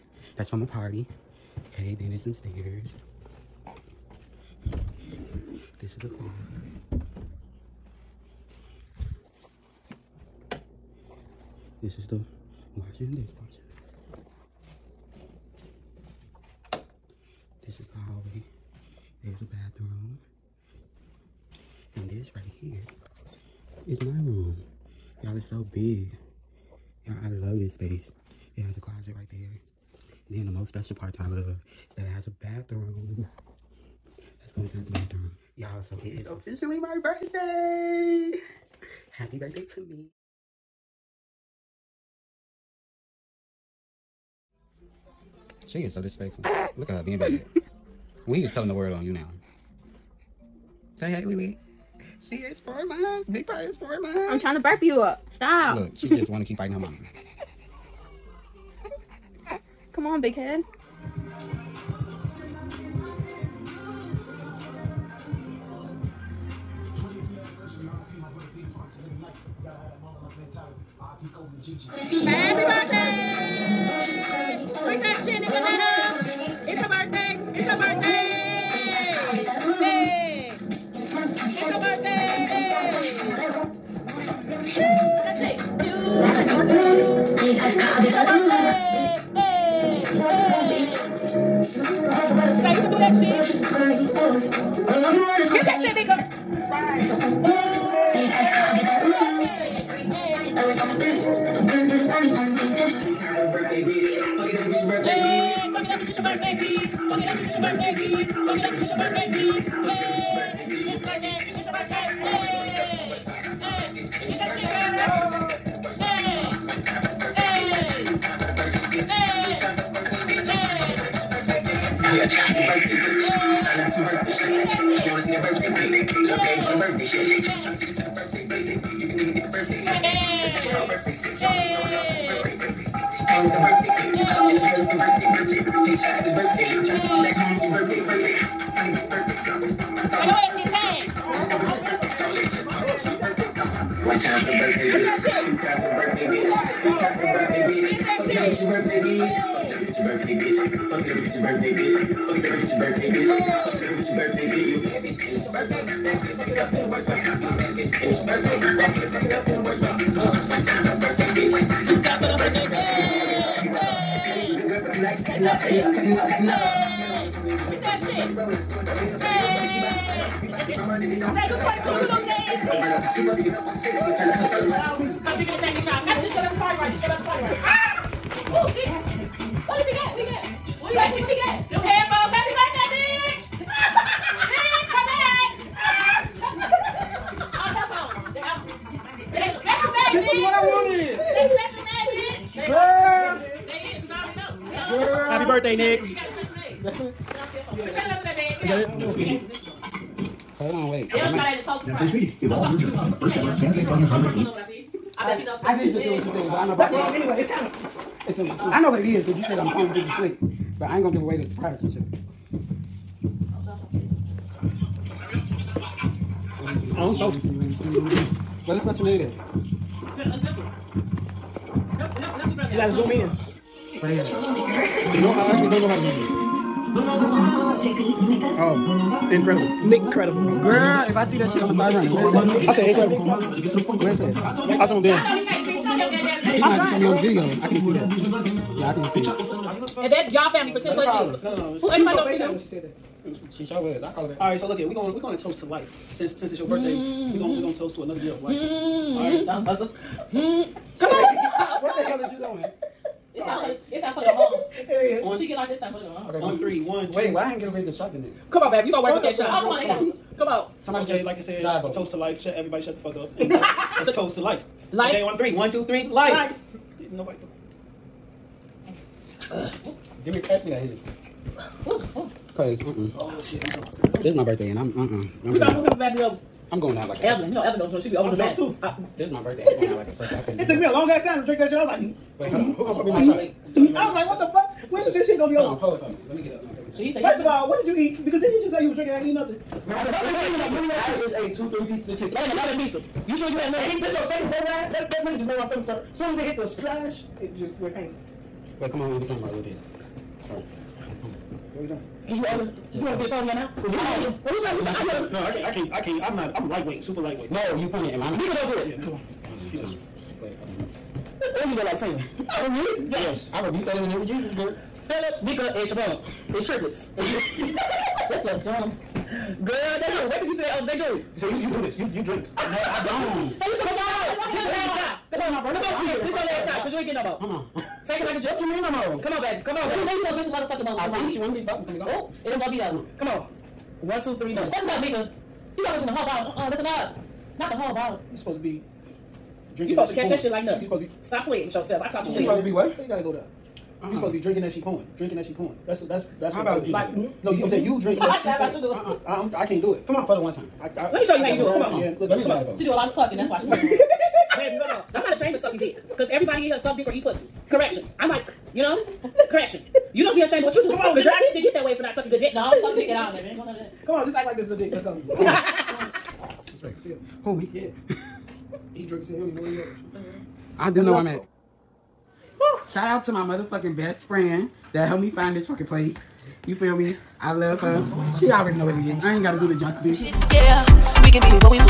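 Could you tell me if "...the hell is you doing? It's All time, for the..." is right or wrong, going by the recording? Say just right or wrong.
right.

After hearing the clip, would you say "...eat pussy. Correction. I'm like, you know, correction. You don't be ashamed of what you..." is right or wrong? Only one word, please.
right.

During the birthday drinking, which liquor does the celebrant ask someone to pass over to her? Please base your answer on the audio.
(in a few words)
Henny.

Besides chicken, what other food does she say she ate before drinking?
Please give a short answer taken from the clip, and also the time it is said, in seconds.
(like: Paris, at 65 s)
pizza, at 292 s.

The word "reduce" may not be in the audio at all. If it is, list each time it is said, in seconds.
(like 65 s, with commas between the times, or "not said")
not said.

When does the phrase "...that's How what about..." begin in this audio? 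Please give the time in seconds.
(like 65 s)
346 s.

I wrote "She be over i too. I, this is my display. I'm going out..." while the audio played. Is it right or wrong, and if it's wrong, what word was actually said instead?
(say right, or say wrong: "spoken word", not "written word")
wrong: "birthday", not "display".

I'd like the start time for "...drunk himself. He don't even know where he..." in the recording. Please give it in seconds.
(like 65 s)
369 s.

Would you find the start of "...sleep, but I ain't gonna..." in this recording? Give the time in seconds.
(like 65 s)
210 s.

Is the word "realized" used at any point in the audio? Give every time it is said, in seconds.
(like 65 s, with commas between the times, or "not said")
not said.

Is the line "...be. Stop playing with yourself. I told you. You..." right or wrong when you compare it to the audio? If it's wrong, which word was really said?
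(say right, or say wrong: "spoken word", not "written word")
right.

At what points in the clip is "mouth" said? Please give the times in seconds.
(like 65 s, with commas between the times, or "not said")
303 s, 308 s.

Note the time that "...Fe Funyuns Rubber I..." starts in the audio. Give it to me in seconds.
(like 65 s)
203 s.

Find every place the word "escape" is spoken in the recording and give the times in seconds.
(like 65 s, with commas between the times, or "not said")
not said.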